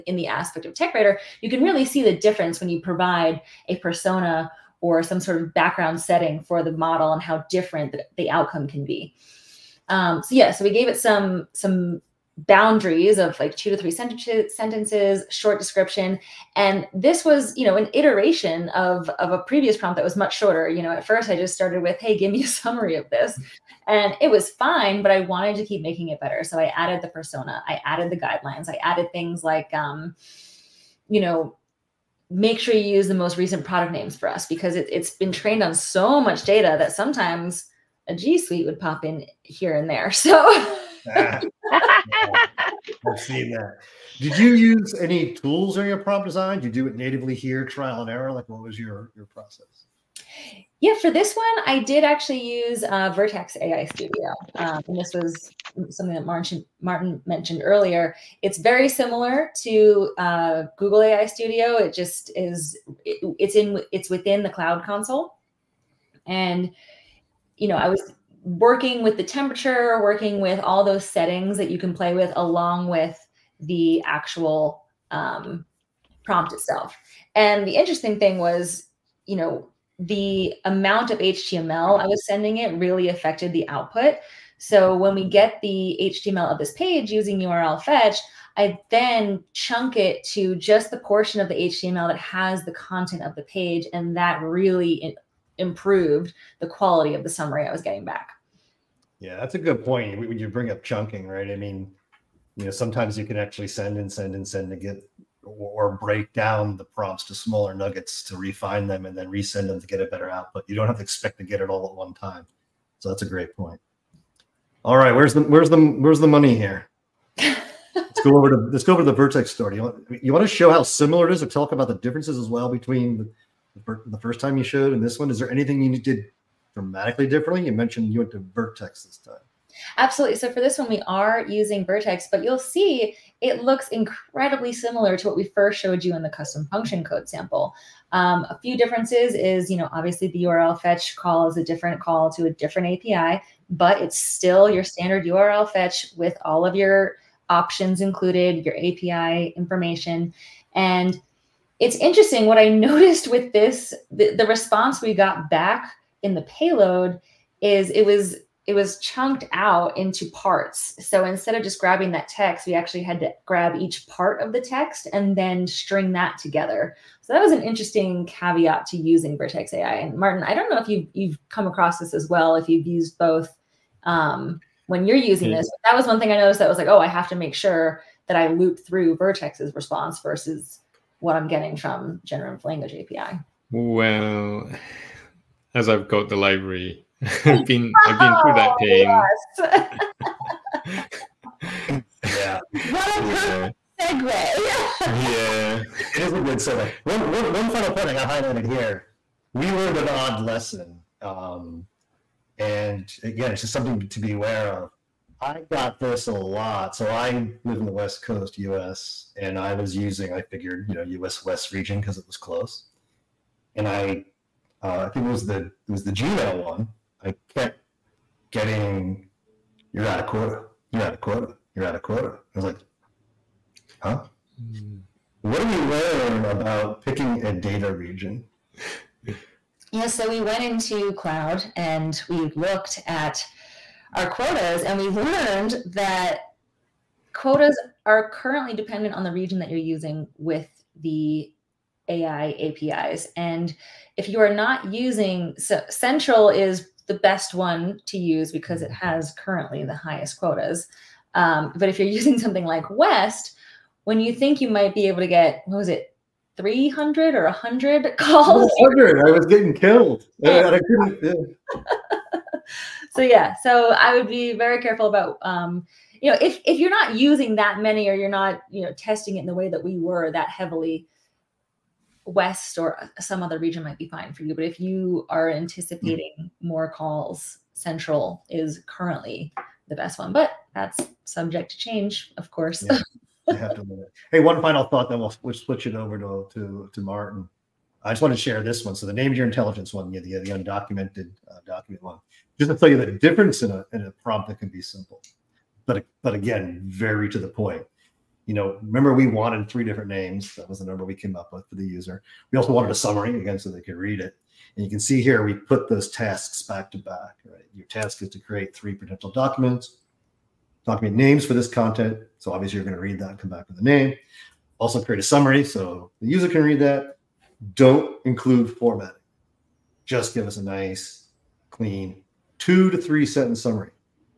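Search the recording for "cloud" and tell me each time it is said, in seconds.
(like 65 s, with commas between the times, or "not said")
64 s, 231 s.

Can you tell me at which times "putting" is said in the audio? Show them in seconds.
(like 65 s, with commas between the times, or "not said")
not said.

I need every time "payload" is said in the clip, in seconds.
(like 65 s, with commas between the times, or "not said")
156 s.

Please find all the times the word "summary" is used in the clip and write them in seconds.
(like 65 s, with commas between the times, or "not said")
22 s, 97 s, 302 s, 315 s, 323 s.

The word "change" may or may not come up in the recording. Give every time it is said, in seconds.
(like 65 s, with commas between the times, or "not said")
281 s.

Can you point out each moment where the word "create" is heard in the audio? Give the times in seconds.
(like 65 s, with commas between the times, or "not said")
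308 s, 315 s.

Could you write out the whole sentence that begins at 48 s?
Like, what was your your process?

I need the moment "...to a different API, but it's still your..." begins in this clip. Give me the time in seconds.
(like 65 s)
142 s.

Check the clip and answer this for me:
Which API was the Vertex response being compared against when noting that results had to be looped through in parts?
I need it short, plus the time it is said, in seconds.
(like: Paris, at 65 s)
Generative Language API, at 182 s.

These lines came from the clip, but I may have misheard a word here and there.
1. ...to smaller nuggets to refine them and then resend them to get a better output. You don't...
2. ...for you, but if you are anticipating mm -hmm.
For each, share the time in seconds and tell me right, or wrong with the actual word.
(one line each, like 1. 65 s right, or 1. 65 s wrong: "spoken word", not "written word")
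1. 107 s right
2. 274 s right.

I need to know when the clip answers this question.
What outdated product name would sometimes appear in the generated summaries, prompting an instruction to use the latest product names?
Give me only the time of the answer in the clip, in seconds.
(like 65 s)
38 s.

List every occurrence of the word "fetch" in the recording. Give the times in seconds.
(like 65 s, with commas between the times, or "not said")
87 s, 140 s, 145 s.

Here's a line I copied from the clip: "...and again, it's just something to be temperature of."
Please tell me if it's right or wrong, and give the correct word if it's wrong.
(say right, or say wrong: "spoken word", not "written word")
wrong: "aware", not "temperature".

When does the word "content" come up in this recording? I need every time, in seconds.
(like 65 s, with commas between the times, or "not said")
92 s, 311 s.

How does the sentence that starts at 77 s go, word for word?
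And the interesting thing was, you know, the amount of HTML I was sending it really affected the output.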